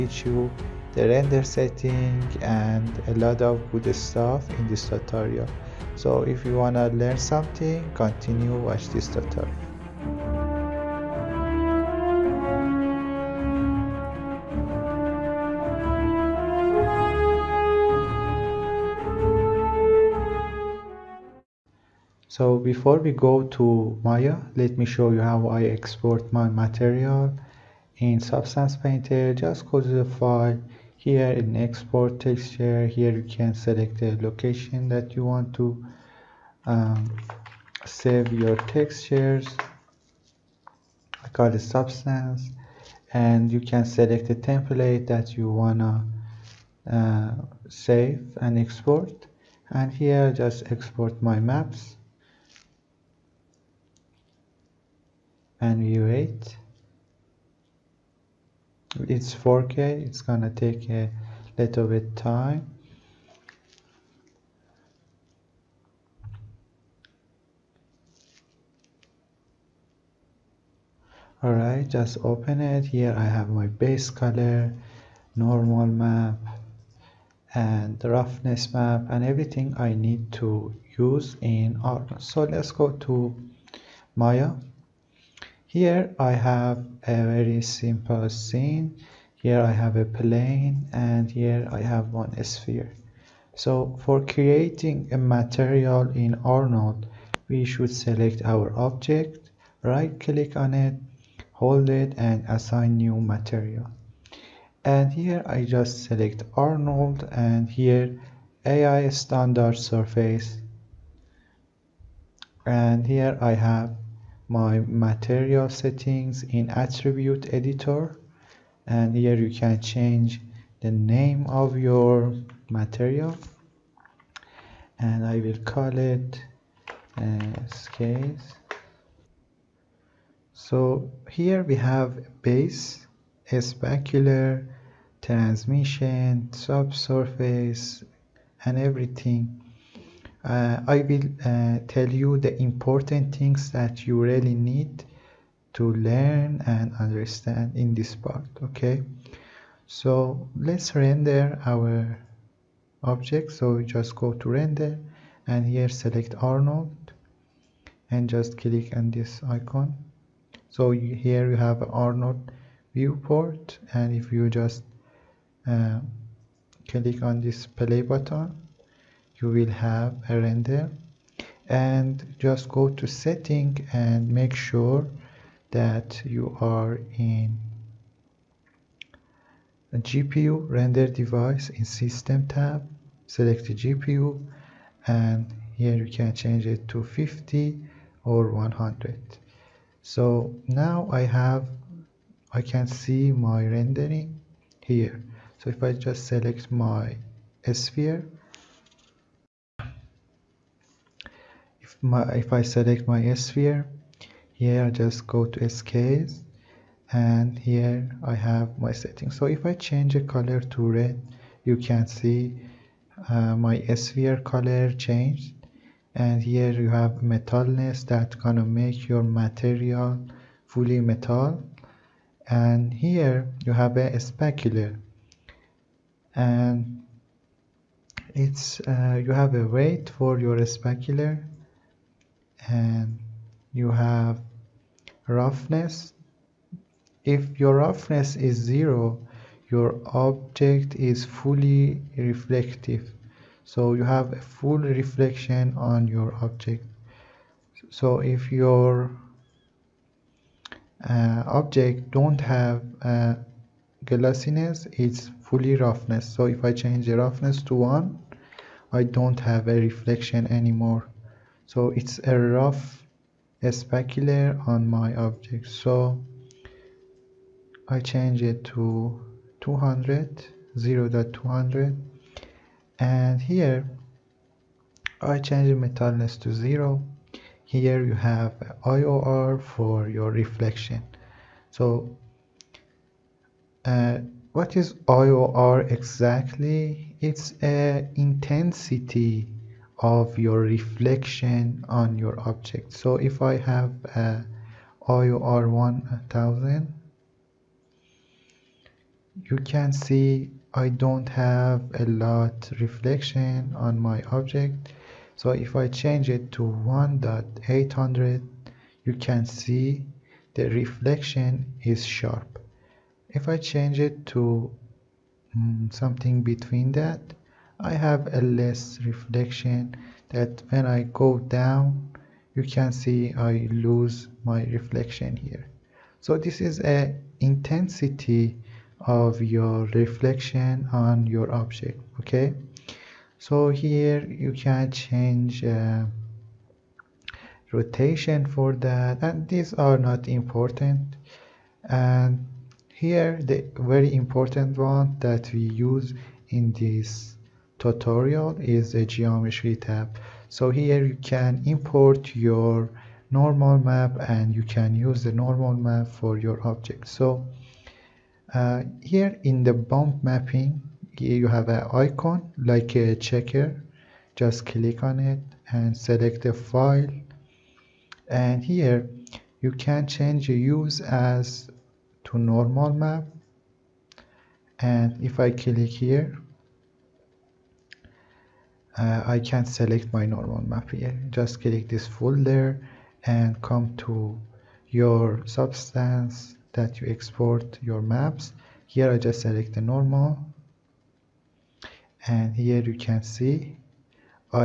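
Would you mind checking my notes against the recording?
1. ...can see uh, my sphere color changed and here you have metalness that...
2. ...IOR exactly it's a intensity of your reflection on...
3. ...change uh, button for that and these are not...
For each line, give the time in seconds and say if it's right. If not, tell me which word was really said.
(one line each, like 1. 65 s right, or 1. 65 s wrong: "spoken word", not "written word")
1. 211 s right
2. 285 s right
3. 334 s wrong: "rotation", not "button".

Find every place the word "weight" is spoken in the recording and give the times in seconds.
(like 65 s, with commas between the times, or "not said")
229 s.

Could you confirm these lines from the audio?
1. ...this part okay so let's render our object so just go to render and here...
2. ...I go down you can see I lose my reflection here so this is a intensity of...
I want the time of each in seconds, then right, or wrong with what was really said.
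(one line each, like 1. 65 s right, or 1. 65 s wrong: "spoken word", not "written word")
1. 147 s right
2. 320 s right.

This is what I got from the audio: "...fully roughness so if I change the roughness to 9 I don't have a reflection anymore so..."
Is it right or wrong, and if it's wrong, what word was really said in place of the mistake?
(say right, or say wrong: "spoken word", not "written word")
wrong: "1", not "9".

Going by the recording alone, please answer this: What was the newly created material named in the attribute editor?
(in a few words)
case.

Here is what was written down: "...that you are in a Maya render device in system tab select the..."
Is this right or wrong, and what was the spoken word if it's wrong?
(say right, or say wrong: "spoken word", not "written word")
wrong: "GPU", not "Maya".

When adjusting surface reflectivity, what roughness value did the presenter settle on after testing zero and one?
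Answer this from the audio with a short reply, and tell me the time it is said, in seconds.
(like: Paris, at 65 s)
0.2, at 270 s.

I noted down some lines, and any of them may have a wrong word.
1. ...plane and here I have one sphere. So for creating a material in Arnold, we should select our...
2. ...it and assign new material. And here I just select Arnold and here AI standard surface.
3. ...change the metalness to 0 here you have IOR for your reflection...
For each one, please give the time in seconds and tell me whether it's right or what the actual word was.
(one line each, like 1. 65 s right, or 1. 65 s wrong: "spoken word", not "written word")
1. 90 s right
2. 101 s right
3. 275 s right.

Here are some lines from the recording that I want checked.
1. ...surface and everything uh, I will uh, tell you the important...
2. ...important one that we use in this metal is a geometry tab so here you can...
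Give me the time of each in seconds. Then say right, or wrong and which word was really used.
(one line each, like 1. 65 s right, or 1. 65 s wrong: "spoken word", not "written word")
1. 136 s wrong: "subsurface", not "surface"
2. 344 s wrong: "tutorial", not "metal".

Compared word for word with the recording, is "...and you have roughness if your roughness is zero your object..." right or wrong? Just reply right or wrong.
right.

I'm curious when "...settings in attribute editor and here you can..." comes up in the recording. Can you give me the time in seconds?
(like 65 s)
115 s.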